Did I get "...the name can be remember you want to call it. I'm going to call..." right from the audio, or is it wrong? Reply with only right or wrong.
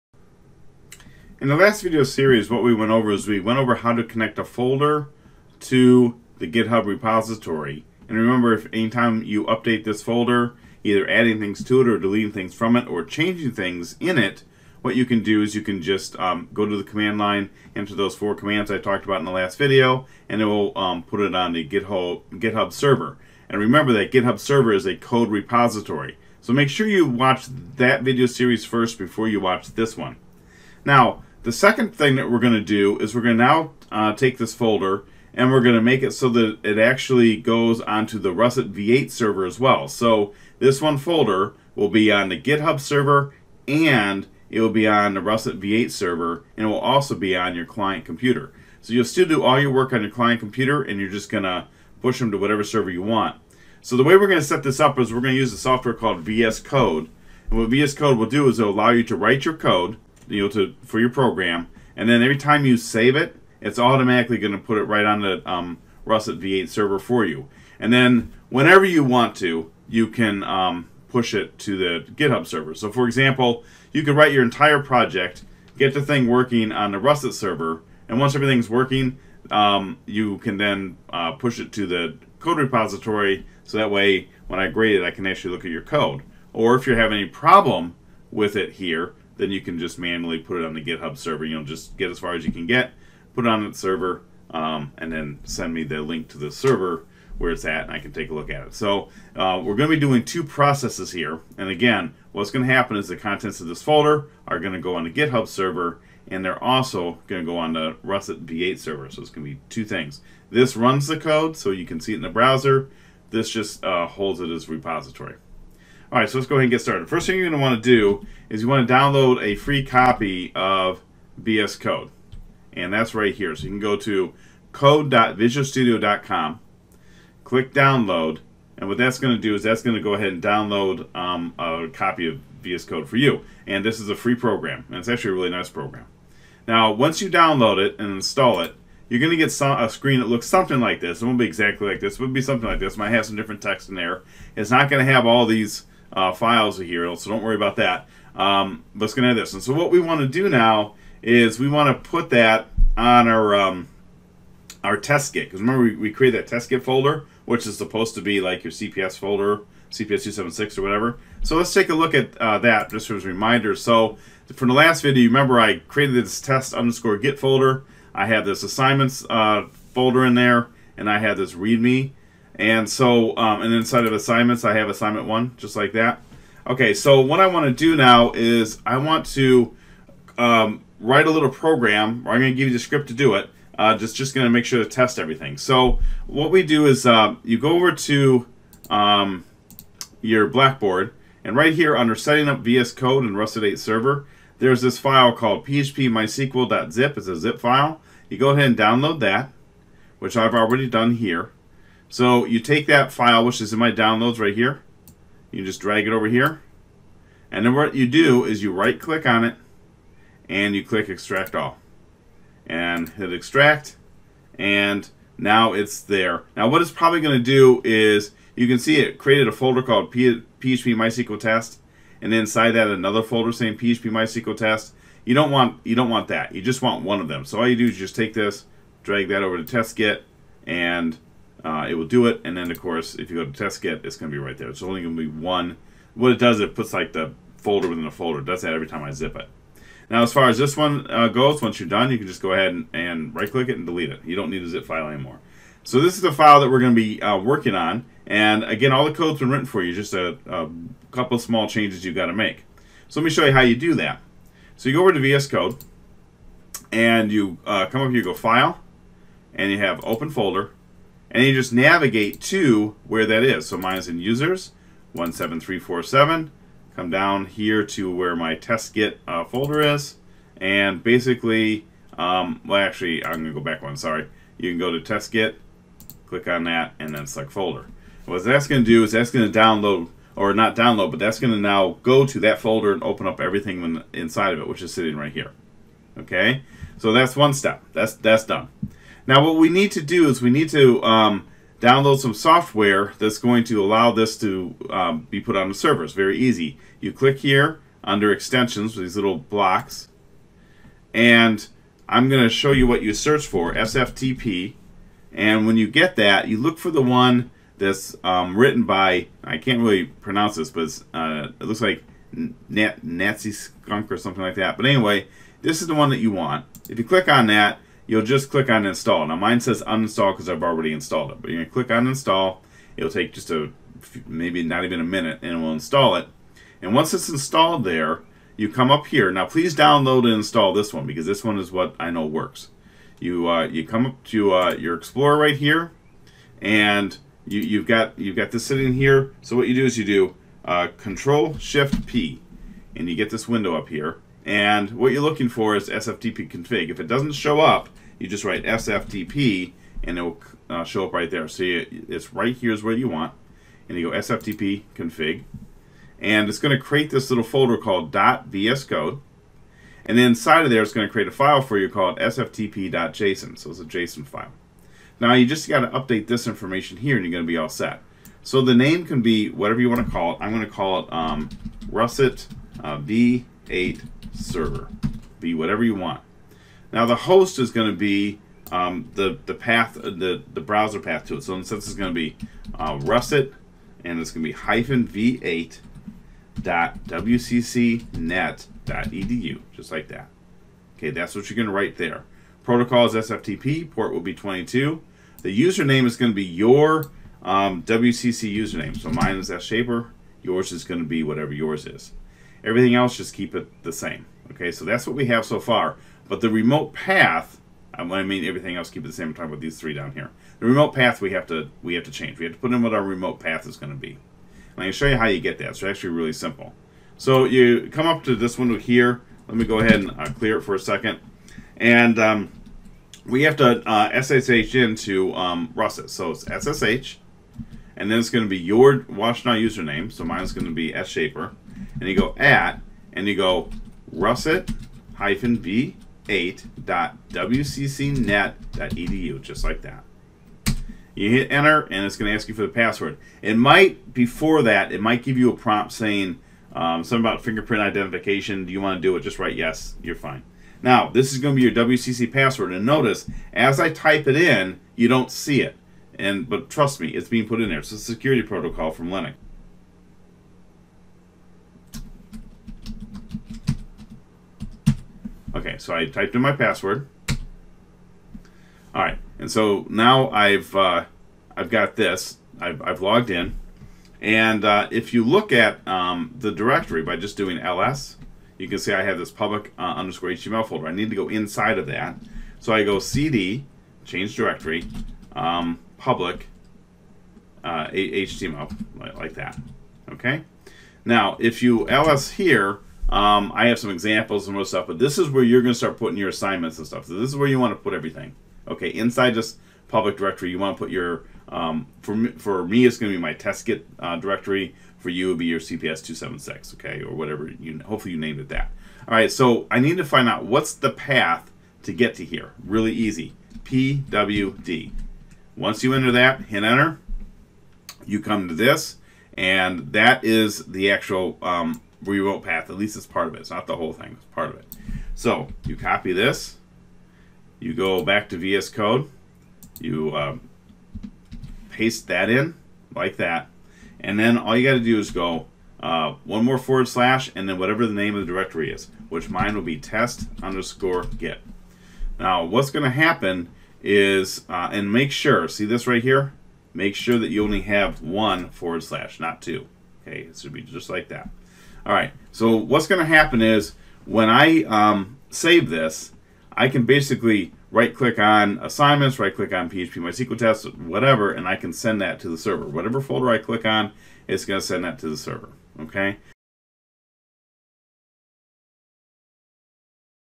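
wrong.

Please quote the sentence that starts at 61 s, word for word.
And then every time you save it, it's automatically going to put it right on the um, Russet V8 server for you.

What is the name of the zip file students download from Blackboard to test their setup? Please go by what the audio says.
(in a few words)
phpmysql.zip.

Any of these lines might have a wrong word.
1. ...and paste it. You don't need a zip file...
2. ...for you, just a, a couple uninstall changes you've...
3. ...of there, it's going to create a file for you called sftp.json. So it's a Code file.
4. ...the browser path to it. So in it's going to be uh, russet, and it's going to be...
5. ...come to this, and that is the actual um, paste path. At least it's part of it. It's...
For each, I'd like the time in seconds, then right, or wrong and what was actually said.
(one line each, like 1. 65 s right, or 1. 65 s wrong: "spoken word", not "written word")
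1. 243 s wrong: "delete", not "paste"
2. 249 s wrong: "small", not "uninstall"
3. 360 s wrong: "JSON", not "Code"
4. 380 s right
5. 518 s wrong: "remote", not "paste".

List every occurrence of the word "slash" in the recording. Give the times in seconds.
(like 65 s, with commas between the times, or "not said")
536 s, 548 s.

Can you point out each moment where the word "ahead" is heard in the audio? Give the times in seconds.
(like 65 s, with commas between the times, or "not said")
116 s, 130 s, 198 s, 242 s, 419 s.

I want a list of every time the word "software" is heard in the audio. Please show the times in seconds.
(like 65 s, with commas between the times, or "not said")
55 s, 292 s.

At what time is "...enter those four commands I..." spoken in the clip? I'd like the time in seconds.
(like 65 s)
17 s.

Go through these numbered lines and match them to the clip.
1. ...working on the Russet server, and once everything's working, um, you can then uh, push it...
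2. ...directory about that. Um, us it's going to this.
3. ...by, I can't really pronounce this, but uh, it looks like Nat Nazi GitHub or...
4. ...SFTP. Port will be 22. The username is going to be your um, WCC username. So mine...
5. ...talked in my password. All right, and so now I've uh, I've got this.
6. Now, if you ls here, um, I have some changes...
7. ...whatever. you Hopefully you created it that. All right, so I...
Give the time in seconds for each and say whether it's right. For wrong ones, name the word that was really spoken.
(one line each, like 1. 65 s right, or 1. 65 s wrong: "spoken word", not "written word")
1. 76 s right
2. 147 s wrong: "worry", not "directory"
3. 308 s wrong: "Skunk", not "GitHub"
4. 393 s right
5. 466 s wrong: "typed", not "talked"
6. 491 s wrong: "examples", not "changes"
7. 507 s wrong: "named", not "created".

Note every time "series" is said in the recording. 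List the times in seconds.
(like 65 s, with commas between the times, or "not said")
2 s, 28 s.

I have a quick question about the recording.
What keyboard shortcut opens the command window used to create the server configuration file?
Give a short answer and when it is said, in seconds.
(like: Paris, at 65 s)
Control Shift P, at 340 s.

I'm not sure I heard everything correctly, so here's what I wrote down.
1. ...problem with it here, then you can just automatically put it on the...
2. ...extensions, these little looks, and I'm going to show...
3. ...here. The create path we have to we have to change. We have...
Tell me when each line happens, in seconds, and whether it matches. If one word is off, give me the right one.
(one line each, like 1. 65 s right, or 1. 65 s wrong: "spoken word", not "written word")
1. 87 s wrong: "manually", not "automatically"
2. 298 s wrong: "blocks", not "looks"
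3. 410 s wrong: "remote", not "create".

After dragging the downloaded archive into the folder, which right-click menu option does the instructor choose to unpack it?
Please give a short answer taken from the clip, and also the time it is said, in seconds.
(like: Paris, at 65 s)
Extract all, at 211 s.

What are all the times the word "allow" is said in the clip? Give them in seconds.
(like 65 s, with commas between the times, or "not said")
58 s, 293 s.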